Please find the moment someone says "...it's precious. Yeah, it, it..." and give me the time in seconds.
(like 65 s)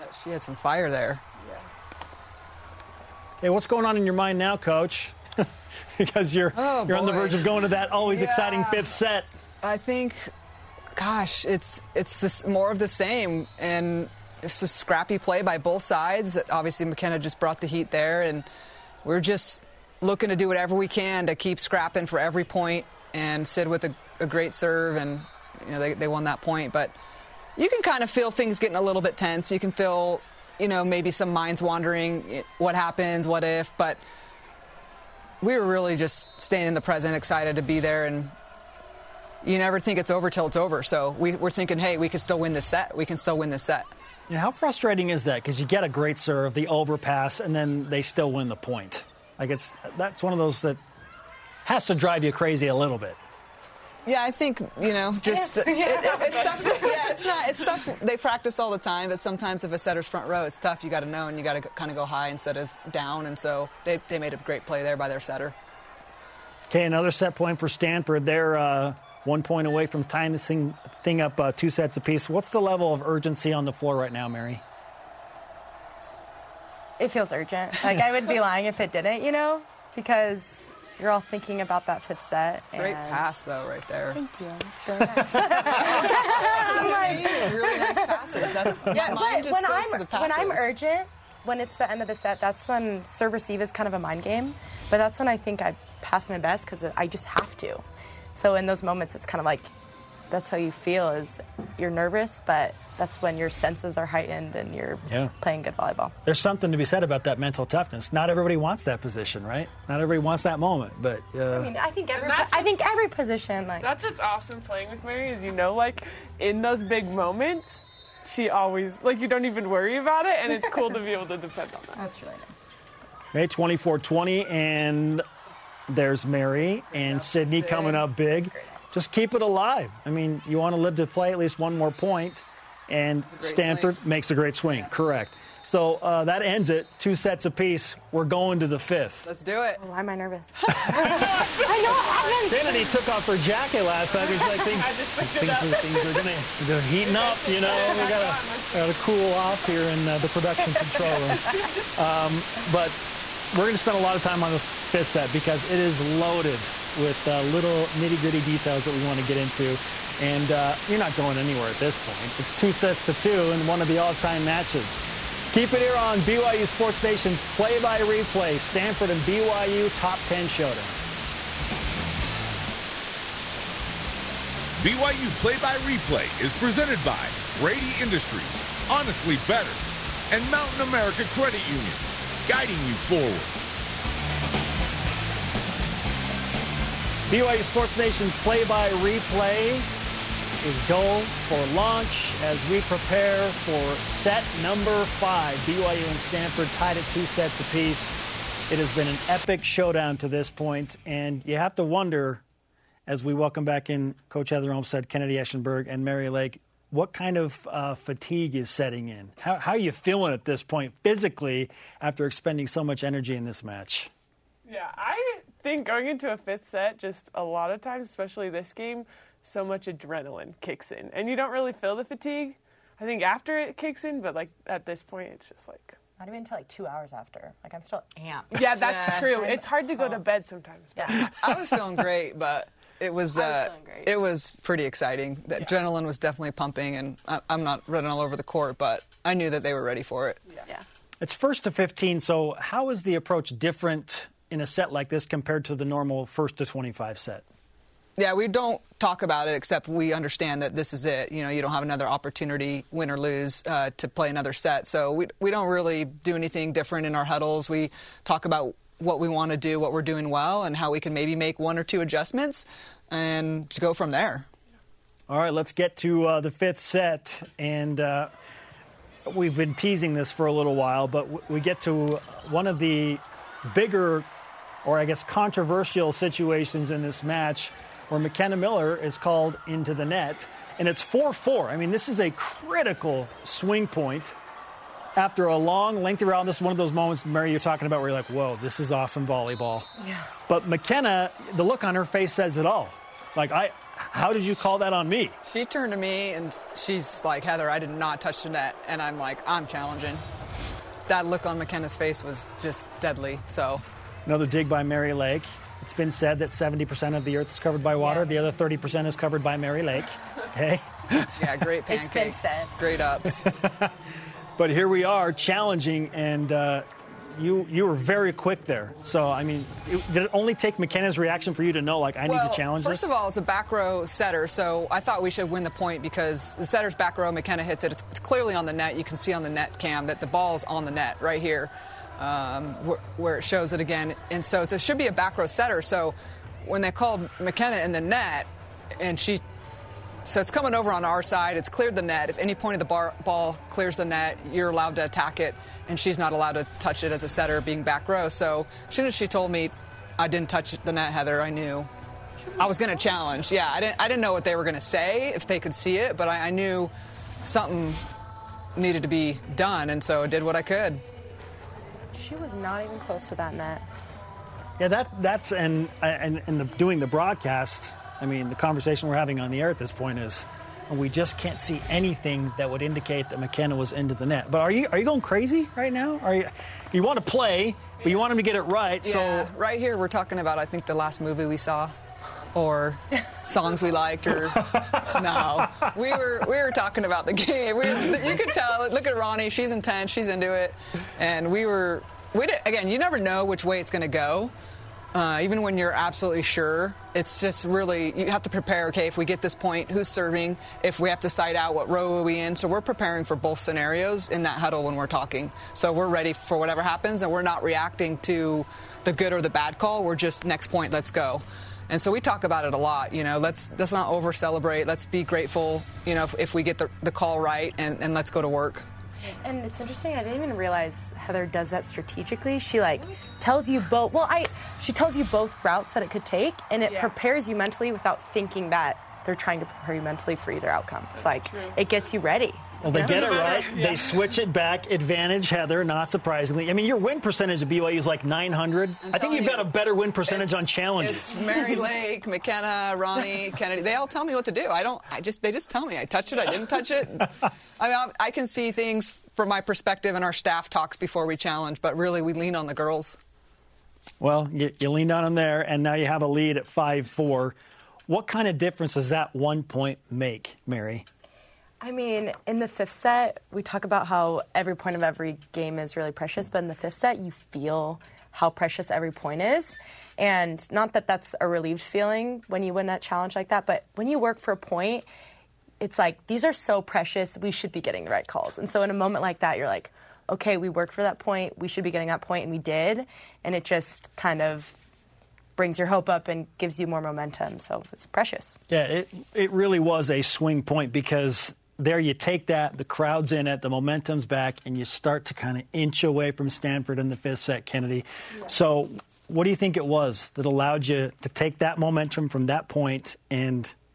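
487 s.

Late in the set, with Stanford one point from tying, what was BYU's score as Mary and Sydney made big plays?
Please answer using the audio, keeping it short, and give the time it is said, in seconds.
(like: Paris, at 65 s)
24-20, at 123 s.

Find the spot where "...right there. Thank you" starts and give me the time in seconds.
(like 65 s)
83 s.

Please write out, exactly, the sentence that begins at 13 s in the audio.
And it's a scrappy play by both sides.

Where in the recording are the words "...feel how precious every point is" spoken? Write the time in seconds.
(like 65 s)
467 s.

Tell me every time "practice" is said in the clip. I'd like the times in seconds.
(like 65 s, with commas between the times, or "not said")
58 s.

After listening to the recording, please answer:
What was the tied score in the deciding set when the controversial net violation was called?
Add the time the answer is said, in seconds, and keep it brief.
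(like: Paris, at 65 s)
4-4, at 281 s.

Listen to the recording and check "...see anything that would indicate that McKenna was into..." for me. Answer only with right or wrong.
right.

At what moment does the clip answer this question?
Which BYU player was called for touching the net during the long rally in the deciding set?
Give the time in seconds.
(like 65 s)
278 s.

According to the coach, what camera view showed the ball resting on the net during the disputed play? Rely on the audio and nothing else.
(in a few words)
net cam.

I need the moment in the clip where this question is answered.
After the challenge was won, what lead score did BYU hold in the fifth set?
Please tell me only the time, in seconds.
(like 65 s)
456 s.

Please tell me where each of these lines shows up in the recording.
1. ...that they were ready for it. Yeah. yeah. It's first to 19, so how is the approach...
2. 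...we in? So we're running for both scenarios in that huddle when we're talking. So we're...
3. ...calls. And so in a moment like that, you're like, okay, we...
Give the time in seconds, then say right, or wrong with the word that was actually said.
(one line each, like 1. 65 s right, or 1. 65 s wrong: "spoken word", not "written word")
1. 239 s wrong: "15", not "19"
2. 402 s wrong: "preparing", not "running"
3. 478 s right.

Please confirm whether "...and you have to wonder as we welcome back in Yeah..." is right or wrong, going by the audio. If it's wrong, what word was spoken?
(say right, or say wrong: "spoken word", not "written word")
wrong: "Coach", not "Yeah".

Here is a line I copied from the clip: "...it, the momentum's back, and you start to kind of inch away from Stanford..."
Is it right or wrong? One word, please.
right.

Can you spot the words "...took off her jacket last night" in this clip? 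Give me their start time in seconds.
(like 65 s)
142 s.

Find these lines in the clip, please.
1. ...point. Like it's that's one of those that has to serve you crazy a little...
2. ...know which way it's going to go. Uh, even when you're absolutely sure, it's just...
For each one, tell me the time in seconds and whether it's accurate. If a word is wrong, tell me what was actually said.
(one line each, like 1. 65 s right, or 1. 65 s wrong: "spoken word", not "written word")
1. 48 s wrong: "drive", not "serve"
2. 393 s right.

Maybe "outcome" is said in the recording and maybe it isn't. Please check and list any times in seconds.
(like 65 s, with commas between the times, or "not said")
430 s.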